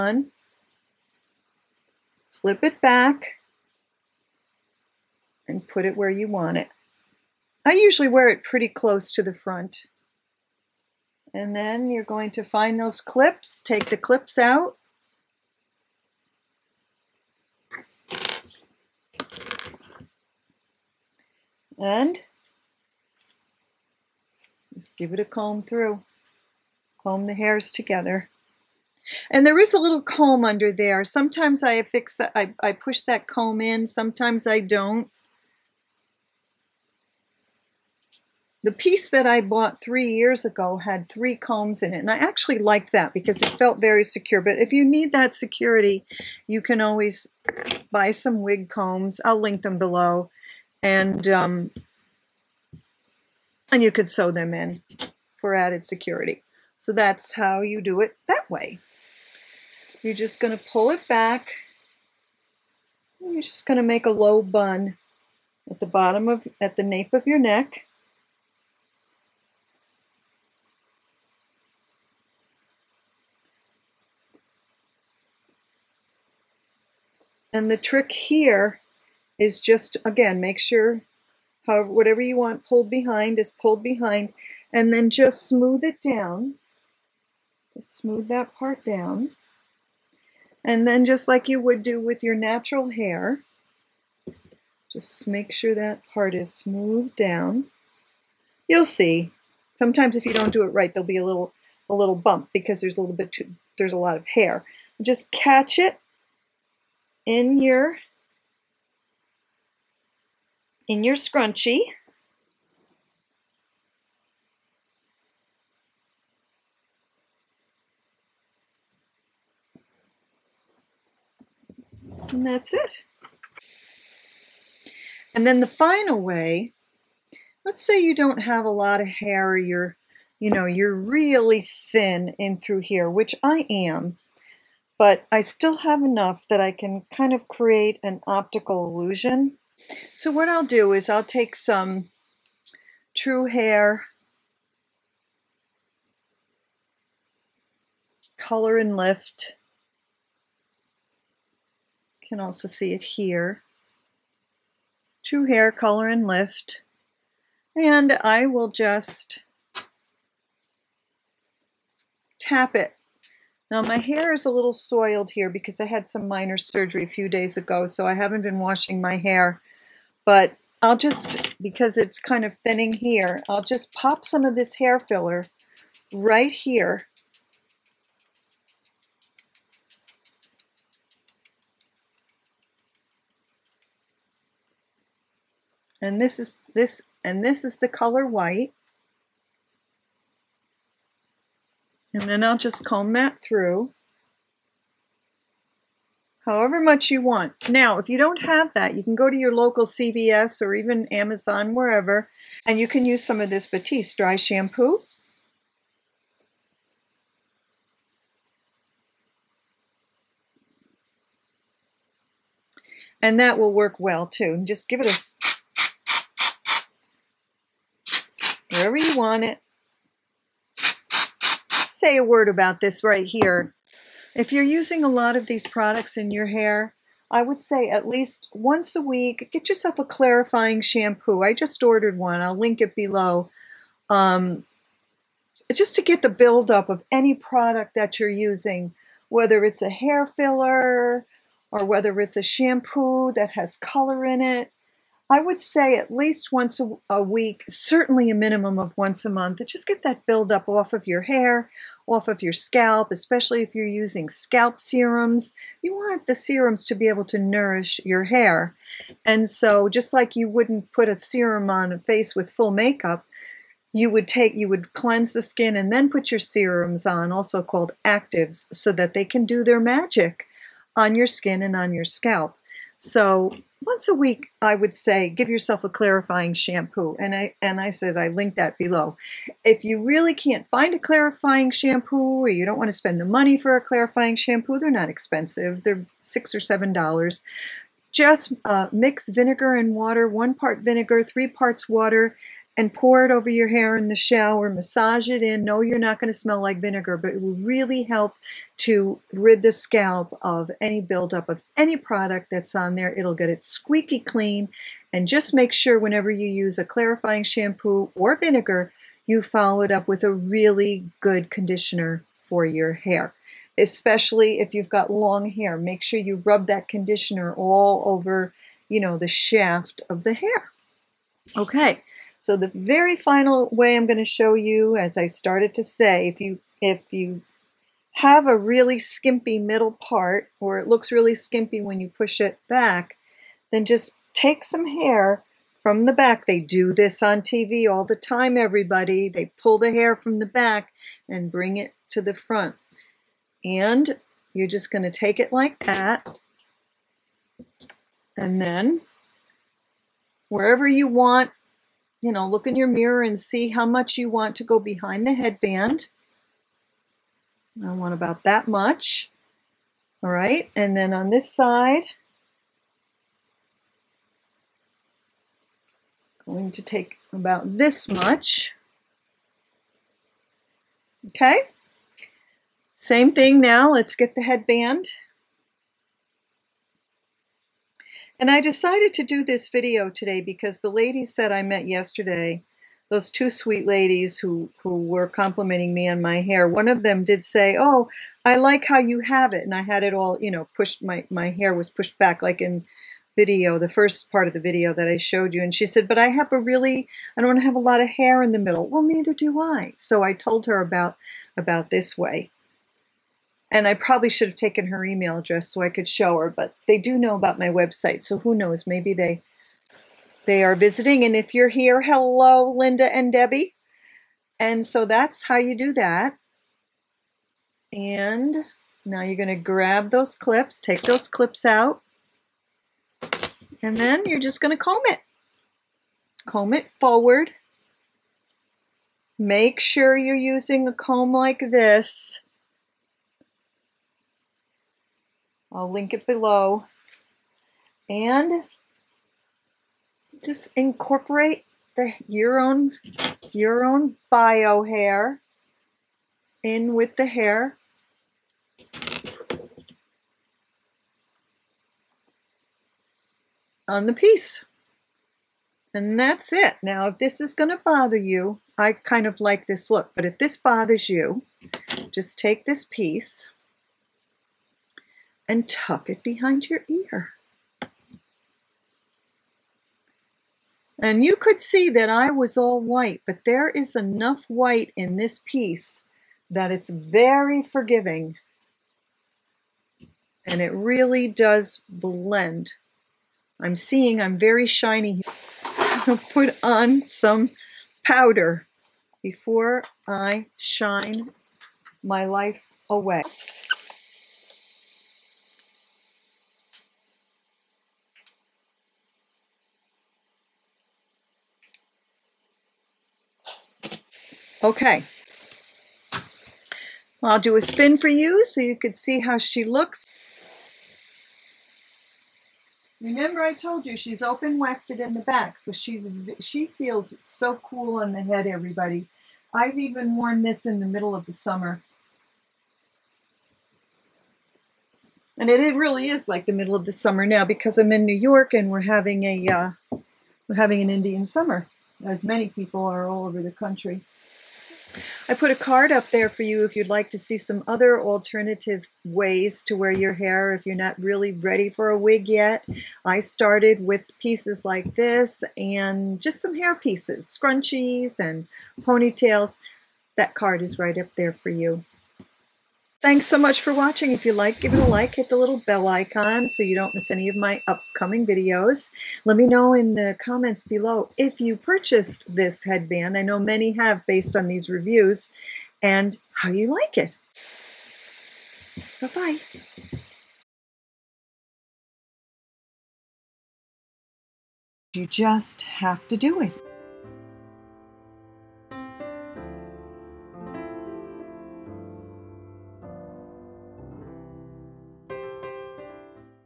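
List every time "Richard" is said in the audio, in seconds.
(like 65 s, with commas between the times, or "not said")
not said.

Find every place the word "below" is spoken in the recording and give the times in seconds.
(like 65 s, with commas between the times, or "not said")
49 s, 232 s, 278 s, 436 s, 560 s.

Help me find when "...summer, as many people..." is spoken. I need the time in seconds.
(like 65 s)
531 s.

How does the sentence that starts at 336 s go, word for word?
They do this on TV all the time, everybody.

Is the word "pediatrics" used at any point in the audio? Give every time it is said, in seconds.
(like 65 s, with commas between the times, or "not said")
not said.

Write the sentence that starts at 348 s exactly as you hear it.
And then wherever you want you know, look in your mirror and see how much you want to go behind the headband.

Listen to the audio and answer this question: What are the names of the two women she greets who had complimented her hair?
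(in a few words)
Linda and Debbie.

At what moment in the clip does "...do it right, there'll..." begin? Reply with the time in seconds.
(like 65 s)
100 s.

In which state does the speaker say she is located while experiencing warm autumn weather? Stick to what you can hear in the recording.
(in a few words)
New York.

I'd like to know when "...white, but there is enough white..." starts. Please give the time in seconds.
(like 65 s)
472 s.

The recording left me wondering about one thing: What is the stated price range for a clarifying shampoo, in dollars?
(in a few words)
6 or 7 dollars.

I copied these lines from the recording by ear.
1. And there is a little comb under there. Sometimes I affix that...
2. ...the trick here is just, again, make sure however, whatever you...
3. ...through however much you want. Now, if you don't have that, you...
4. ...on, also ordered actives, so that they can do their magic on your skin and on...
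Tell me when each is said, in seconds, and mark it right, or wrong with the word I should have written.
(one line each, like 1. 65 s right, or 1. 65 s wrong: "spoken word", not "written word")
1. 29 s right
2. 77 s right
3. 193 s right
4. 267 s wrong: "called", not "ordered".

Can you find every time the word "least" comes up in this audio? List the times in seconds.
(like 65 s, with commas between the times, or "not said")
228 s, 246 s.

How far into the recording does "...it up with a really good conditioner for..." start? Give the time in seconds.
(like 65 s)
309 s.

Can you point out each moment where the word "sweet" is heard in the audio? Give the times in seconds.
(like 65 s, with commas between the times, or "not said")
383 s.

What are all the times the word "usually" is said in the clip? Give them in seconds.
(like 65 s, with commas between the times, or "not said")
7 s.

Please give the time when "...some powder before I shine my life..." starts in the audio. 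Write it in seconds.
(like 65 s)
487 s.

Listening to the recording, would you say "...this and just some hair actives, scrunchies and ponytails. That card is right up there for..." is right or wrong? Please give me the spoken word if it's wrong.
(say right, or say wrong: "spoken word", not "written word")
wrong: "pieces", not "actives".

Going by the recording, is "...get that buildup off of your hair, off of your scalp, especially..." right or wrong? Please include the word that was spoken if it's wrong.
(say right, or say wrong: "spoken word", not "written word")
right.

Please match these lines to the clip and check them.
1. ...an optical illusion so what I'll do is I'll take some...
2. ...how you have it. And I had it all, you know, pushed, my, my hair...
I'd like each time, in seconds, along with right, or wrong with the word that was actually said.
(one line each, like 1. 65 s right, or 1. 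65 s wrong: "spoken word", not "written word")
1. 138 s right
2. 388 s right.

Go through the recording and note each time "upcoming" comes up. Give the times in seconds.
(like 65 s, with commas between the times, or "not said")
557 s.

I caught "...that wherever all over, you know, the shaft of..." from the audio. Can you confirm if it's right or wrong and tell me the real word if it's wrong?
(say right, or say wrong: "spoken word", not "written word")
wrong: "conditioner", not "wherever".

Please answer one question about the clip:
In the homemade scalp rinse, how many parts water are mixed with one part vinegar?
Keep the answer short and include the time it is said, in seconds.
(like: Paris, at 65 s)
3, at 291 s.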